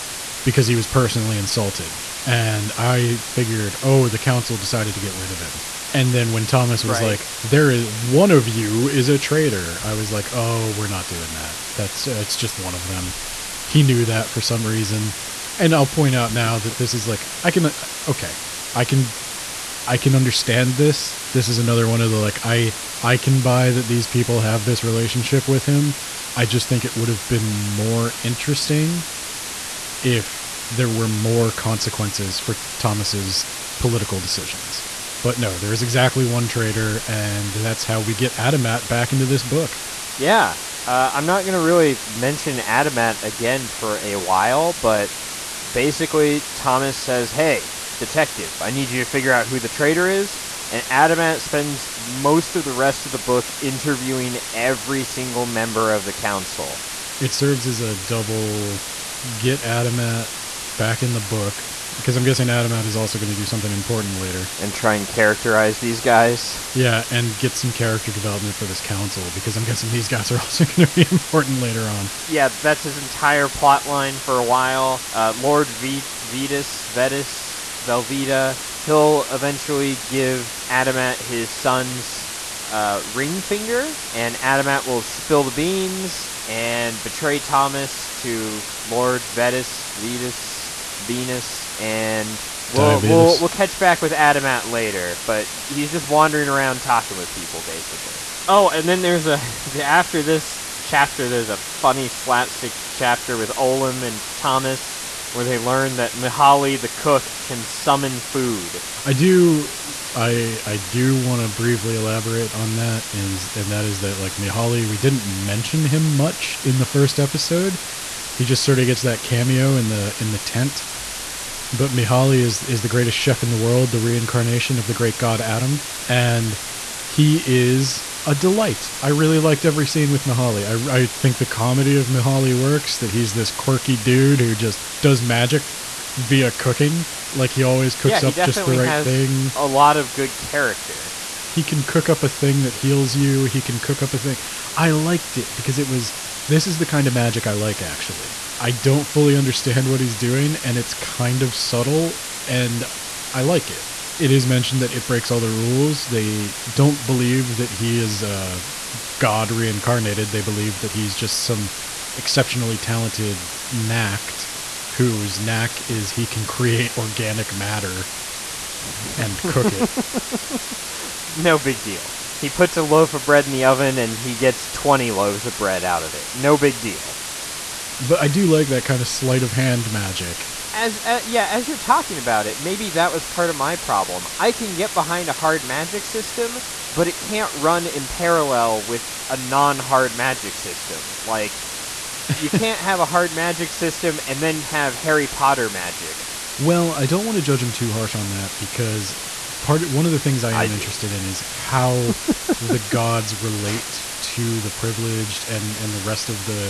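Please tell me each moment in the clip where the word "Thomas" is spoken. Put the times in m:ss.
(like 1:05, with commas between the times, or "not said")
0:06, 0:32, 0:46, 1:27, 1:44.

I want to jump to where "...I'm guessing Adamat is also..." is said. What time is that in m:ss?
1:02.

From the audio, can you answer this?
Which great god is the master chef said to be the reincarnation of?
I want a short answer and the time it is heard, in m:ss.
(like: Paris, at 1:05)
Adom, at 2:05.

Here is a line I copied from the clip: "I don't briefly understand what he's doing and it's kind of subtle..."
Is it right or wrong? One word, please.
wrong.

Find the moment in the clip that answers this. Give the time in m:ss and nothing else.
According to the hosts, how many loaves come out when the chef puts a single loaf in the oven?
2:54.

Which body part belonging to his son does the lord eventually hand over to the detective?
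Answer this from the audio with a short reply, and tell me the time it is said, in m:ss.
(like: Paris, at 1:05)
ring finger, at 1:23.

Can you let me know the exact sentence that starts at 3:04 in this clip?
I can get behind a hard magic system, but it can't run in parallel with a non-hard magic system.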